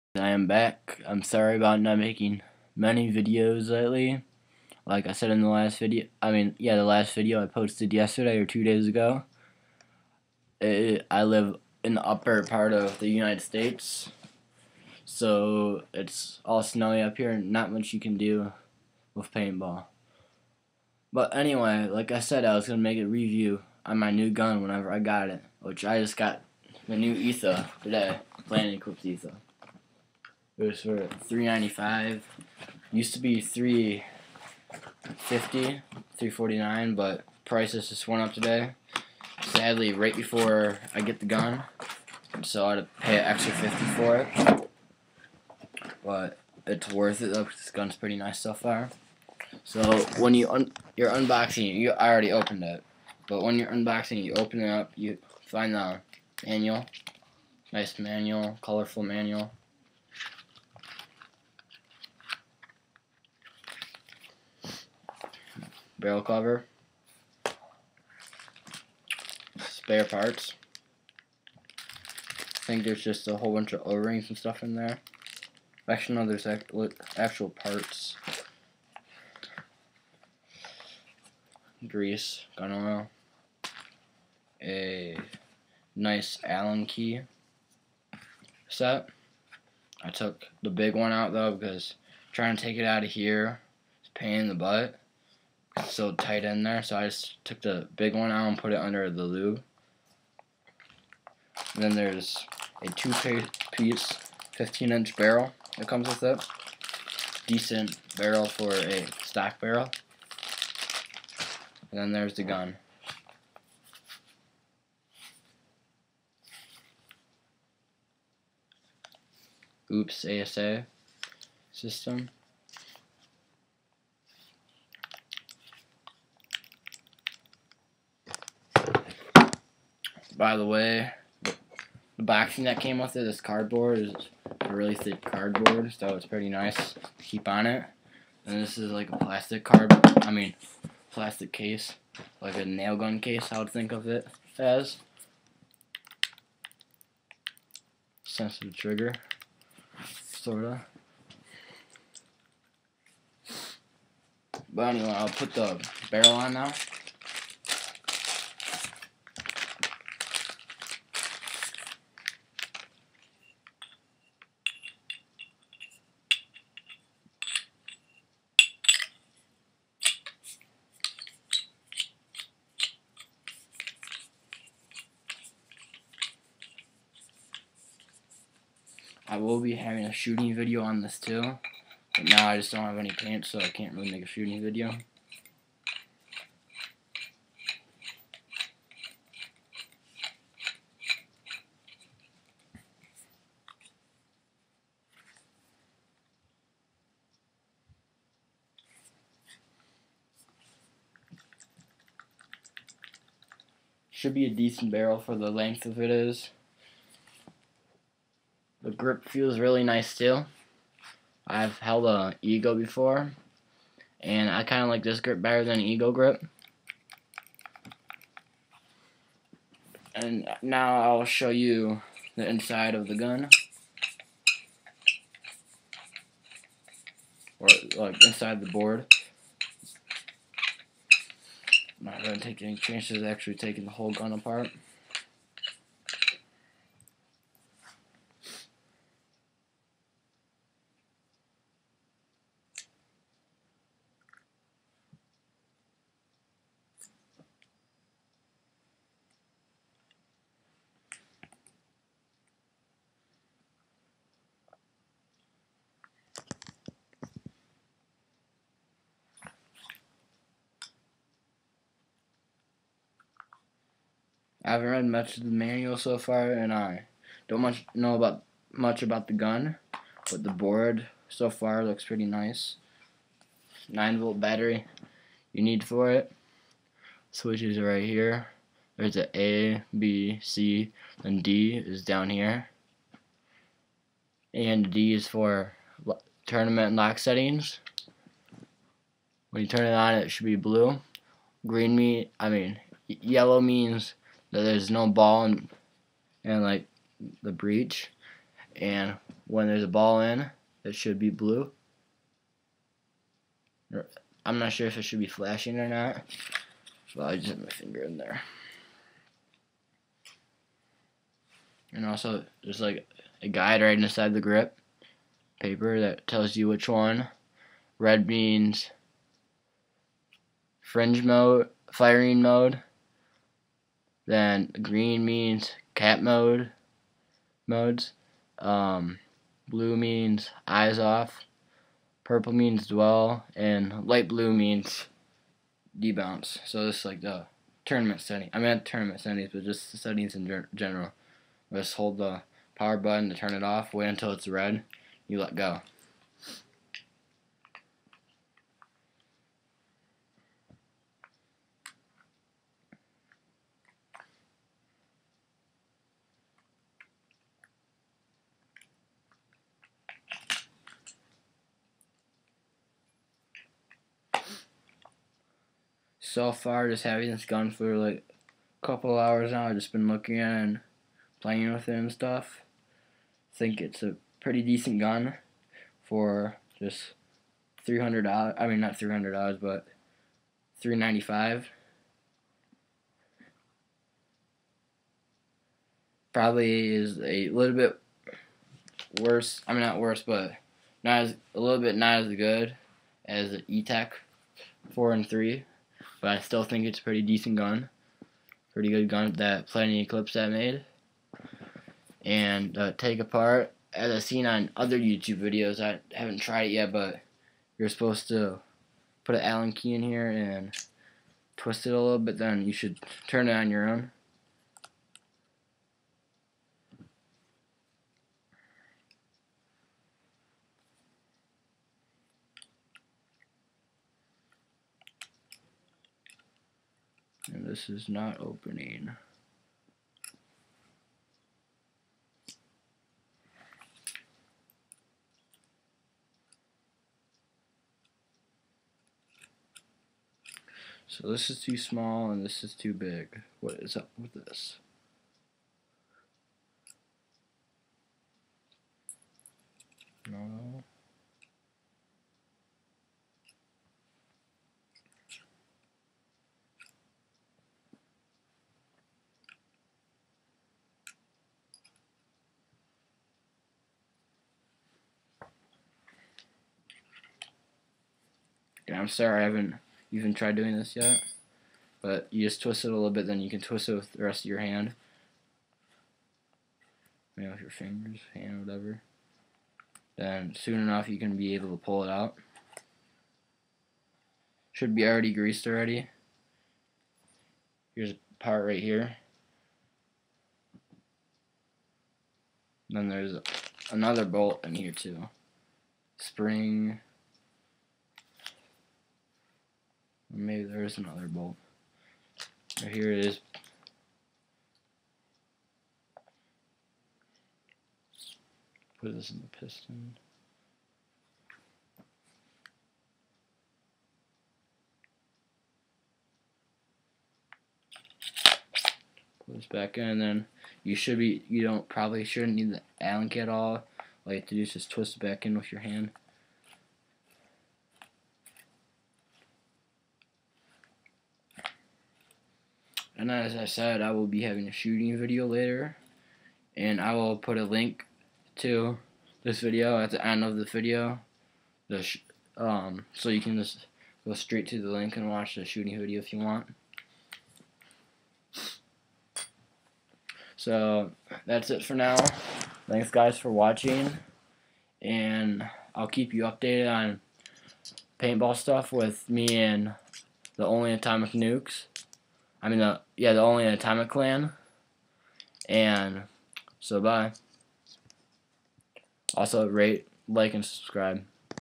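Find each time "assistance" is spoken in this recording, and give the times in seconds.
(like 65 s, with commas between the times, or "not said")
not said.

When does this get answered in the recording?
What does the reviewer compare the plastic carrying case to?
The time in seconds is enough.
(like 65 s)
142 s.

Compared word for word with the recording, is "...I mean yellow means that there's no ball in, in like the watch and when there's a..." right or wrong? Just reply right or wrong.
wrong.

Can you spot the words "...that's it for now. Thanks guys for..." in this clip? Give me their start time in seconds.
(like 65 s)
551 s.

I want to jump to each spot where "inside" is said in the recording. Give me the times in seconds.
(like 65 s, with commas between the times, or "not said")
222 s, 228 s, 313 s.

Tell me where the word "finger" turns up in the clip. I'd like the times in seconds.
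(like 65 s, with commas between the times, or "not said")
307 s, 477 s.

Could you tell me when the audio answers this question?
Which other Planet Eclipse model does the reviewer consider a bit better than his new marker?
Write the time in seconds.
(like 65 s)
393 s.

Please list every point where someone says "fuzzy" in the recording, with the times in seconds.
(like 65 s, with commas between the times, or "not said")
not said.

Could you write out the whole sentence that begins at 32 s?
Used to be three fifty, three forty nine, but prices just went up today.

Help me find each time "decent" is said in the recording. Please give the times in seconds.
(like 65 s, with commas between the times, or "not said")
107 s, 204 s, 374 s, 397 s.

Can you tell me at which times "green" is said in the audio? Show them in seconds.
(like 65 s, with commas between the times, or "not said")
291 s, 324 s.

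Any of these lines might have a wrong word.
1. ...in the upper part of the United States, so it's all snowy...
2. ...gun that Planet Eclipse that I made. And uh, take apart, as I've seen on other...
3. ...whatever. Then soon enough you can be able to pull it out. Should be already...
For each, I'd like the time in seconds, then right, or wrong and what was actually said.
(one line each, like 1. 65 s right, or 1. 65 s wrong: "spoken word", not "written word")
1. 11 s right
2. 399 s right
3. 478 s right.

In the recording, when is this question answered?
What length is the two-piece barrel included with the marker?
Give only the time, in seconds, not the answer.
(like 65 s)
104 s.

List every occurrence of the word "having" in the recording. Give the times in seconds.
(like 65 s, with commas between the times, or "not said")
179 s, 367 s, 534 s.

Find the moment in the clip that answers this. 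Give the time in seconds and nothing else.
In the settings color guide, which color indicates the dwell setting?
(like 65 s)
332 s.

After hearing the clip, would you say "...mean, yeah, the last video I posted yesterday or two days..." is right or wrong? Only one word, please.
right.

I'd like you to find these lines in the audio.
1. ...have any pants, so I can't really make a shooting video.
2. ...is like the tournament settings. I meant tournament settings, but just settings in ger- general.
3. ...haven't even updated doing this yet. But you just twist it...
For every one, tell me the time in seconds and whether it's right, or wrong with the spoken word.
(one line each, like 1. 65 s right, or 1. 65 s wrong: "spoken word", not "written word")
1. 182 s right
2. 336 s right
3. 469 s wrong: "tried", not "updated".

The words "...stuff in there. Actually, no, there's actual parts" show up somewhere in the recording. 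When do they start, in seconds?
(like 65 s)
74 s.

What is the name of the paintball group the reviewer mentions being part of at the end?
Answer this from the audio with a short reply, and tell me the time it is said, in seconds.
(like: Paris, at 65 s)
Atomic Clan, at 563 s.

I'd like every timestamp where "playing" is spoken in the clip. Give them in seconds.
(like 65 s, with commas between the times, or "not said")
371 s.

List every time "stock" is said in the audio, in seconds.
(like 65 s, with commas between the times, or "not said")
109 s.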